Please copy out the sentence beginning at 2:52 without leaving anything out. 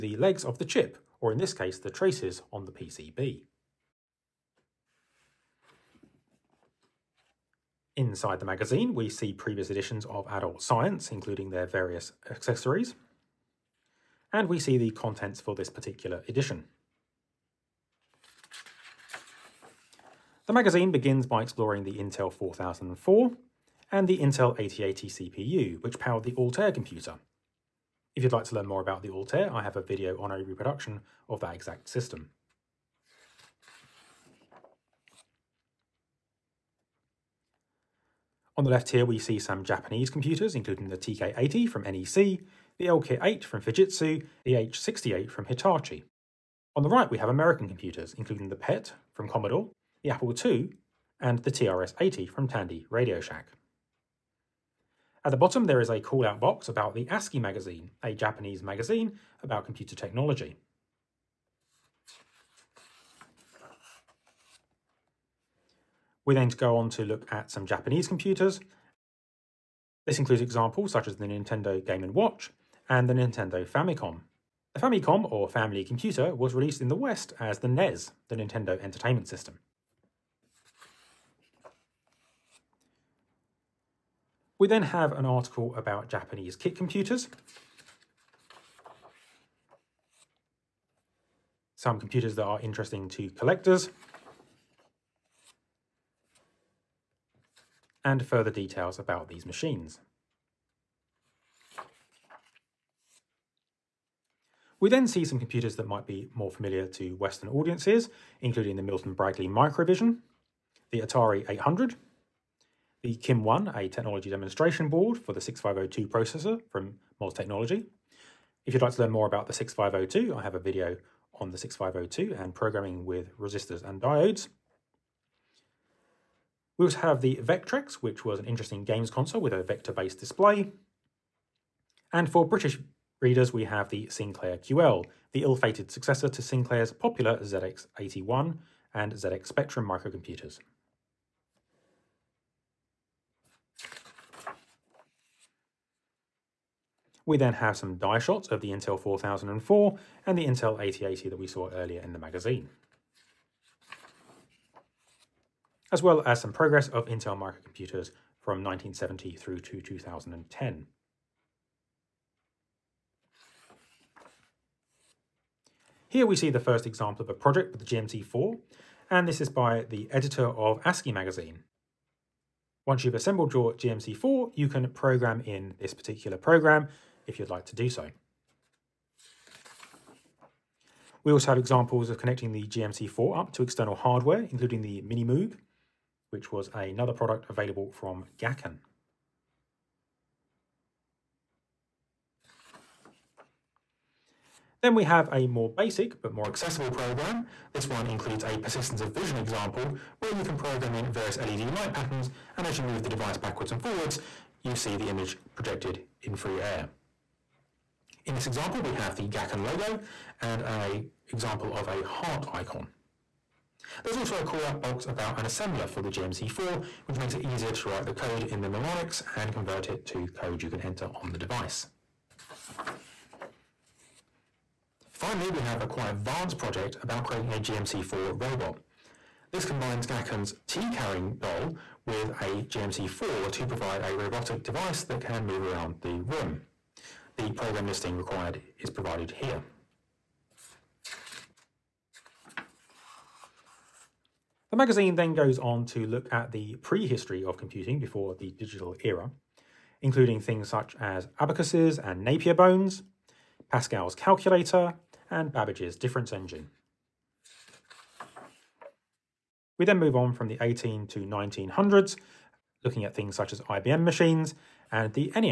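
Once you've assembled your GMC4, you can program in this particular program if you'd like to do so.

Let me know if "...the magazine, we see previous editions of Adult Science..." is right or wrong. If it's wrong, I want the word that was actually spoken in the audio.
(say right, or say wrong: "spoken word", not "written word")
right.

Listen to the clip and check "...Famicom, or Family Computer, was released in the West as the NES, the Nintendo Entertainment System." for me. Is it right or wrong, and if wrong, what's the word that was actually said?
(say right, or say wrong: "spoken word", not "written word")
right.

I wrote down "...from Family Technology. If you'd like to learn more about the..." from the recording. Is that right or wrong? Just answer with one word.
wrong.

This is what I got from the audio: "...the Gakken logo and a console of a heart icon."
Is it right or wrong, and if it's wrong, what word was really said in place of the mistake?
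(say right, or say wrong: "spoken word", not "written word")
wrong: "example", not "console".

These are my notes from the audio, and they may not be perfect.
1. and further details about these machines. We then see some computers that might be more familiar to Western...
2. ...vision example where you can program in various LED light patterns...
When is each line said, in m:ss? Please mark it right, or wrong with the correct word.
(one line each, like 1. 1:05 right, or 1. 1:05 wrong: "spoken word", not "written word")
1. 1:38 right
2. 3:19 right.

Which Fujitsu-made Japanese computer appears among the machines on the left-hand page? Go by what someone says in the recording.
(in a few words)
LK8.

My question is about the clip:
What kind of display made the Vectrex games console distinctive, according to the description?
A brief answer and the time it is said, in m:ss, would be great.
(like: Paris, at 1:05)
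Vector-based, at 2:09.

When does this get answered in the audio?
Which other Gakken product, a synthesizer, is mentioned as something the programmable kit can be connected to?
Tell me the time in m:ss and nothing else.
3:05.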